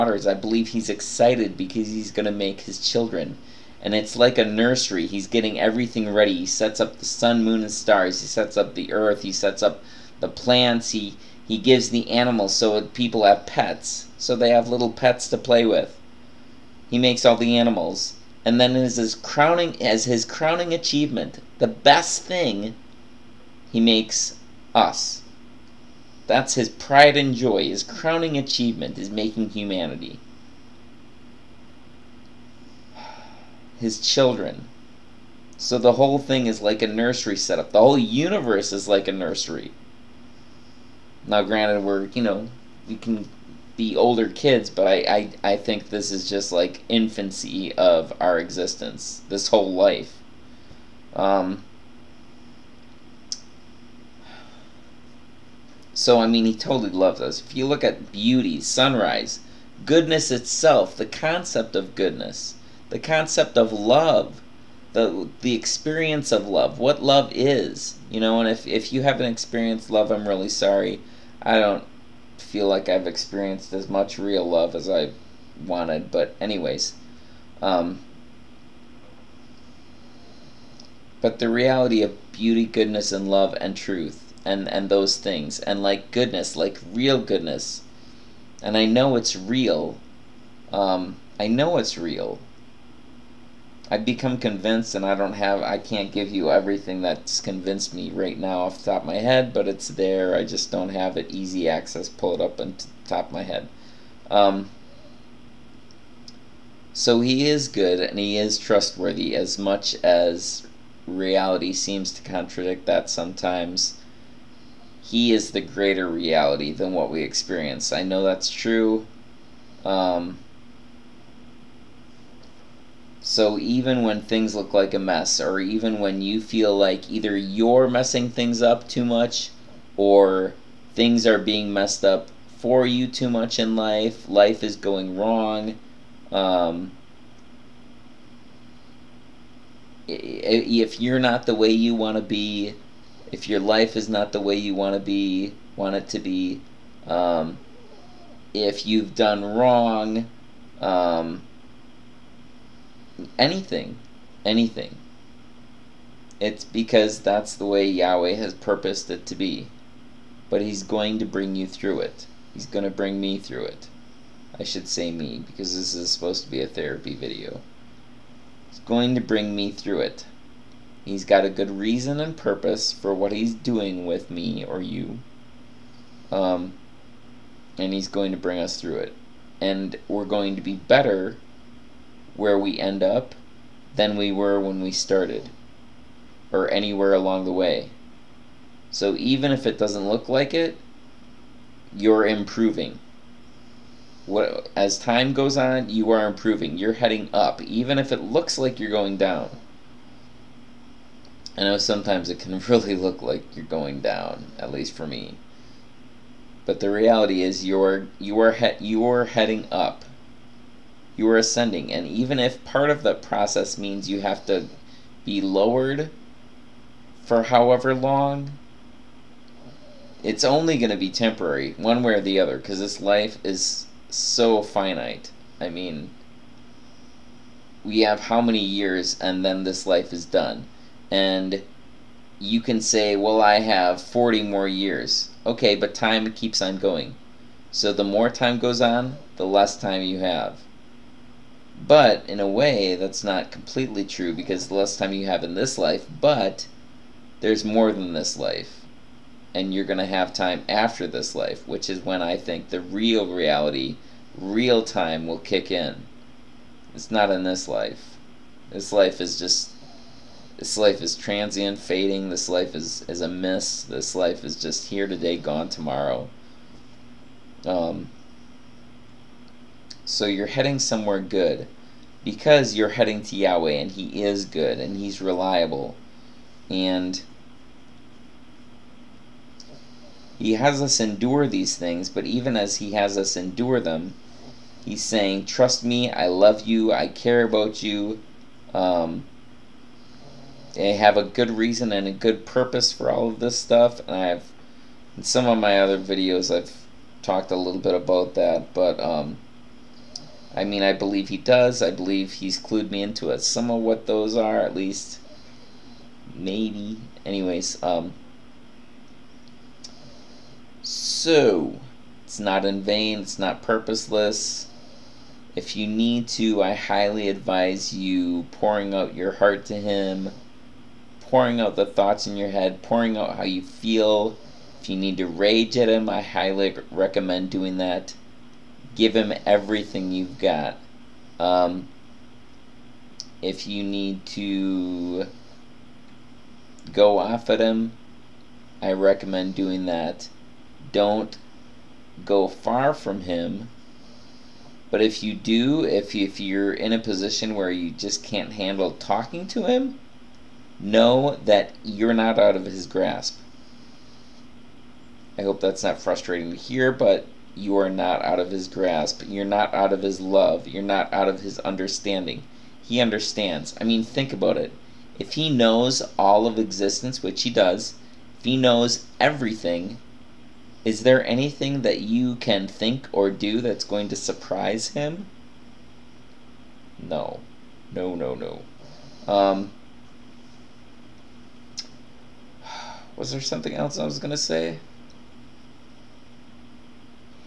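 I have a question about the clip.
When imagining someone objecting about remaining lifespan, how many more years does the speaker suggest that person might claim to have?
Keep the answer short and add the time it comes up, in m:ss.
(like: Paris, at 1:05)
40, at 3:54.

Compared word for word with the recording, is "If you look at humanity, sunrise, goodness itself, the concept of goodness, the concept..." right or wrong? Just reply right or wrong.
wrong.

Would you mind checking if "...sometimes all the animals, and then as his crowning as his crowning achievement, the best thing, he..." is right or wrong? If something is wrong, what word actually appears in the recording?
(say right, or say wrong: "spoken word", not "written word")
wrong: "makes", not "sometimes".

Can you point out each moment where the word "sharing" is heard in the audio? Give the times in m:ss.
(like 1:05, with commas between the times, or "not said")
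not said.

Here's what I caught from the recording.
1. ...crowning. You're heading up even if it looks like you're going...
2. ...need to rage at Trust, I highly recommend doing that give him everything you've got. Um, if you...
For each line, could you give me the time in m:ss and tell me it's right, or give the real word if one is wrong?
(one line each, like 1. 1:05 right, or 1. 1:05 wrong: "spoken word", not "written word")
1. 3:16 wrong: "improving", not "crowning"
2. 5:24 wrong: "Him", not "Trust".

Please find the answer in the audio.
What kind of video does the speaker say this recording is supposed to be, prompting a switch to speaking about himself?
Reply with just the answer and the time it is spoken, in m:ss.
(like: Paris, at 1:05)
A therapy video, at 2:46.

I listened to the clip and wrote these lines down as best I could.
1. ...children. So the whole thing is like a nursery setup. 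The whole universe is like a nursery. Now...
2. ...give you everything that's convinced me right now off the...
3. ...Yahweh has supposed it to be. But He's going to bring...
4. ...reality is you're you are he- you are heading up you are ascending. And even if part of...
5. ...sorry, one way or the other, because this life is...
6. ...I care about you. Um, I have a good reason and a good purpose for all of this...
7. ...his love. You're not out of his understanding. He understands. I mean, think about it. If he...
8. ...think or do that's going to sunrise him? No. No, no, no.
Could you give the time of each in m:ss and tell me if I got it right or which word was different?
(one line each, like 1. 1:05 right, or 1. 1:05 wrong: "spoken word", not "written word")
1. 0:34 right
2. 1:36 right
3. 2:37 wrong: "purposed", not "supposed"
4. 3:26 right
5. 3:41 wrong: "temporary", not "sorry"
6. 4:46 right
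7. 6:00 right
8. 6:12 wrong: "surprise", not "sunrise".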